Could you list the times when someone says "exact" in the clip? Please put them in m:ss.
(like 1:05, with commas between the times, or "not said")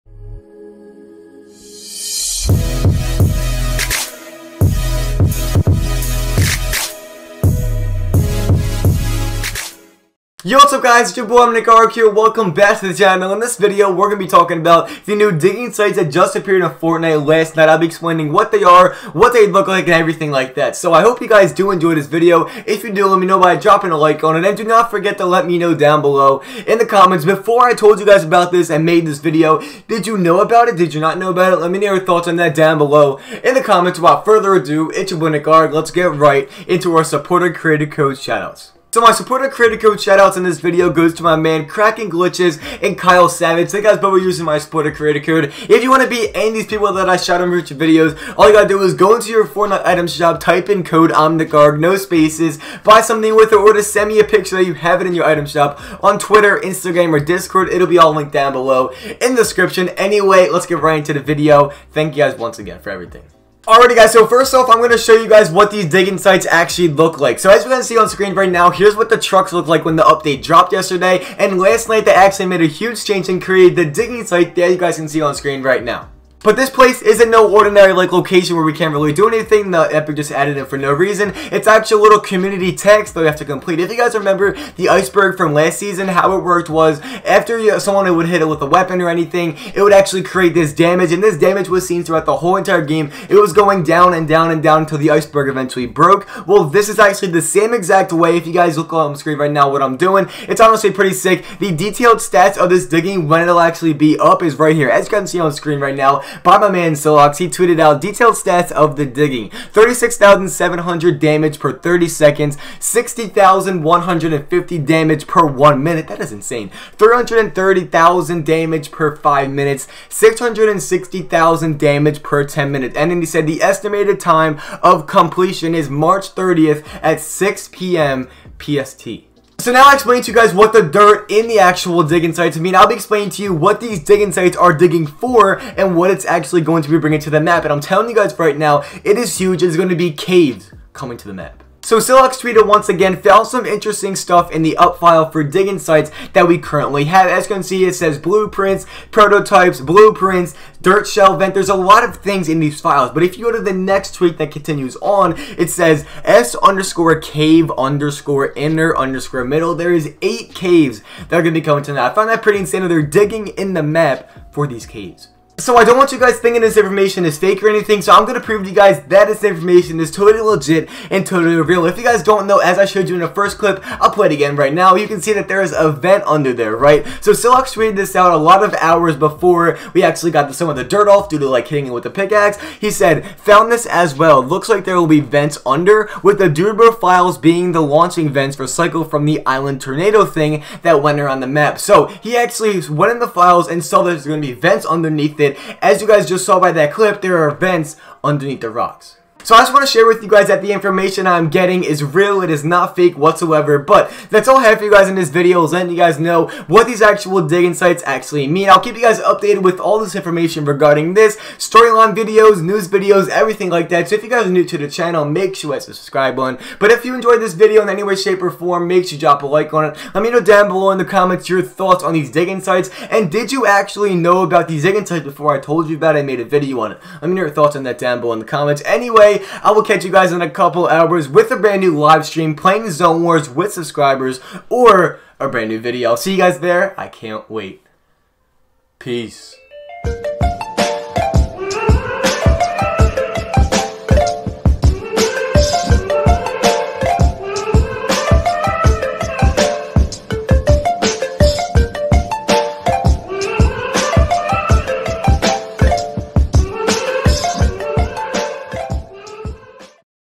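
1:37.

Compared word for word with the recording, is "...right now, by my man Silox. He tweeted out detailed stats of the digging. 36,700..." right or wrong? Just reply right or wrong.
right.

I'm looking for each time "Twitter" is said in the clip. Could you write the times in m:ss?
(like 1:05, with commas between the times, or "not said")
0:56, 2:22.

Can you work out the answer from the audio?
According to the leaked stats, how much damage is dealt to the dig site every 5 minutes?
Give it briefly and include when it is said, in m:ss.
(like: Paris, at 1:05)
330,000, at 1:56.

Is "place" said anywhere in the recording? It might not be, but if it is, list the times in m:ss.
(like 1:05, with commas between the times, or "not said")
1:16.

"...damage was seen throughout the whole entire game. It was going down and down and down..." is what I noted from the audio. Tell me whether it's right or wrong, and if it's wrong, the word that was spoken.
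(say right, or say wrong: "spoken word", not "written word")
right.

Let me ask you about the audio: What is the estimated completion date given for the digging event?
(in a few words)
March 30th.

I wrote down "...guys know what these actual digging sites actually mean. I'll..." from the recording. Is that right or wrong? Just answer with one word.
right.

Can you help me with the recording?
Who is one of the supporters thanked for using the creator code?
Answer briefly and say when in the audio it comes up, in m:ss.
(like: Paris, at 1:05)
Kyle Savage, at 0:42.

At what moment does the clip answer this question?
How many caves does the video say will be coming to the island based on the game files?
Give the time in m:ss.
2:40.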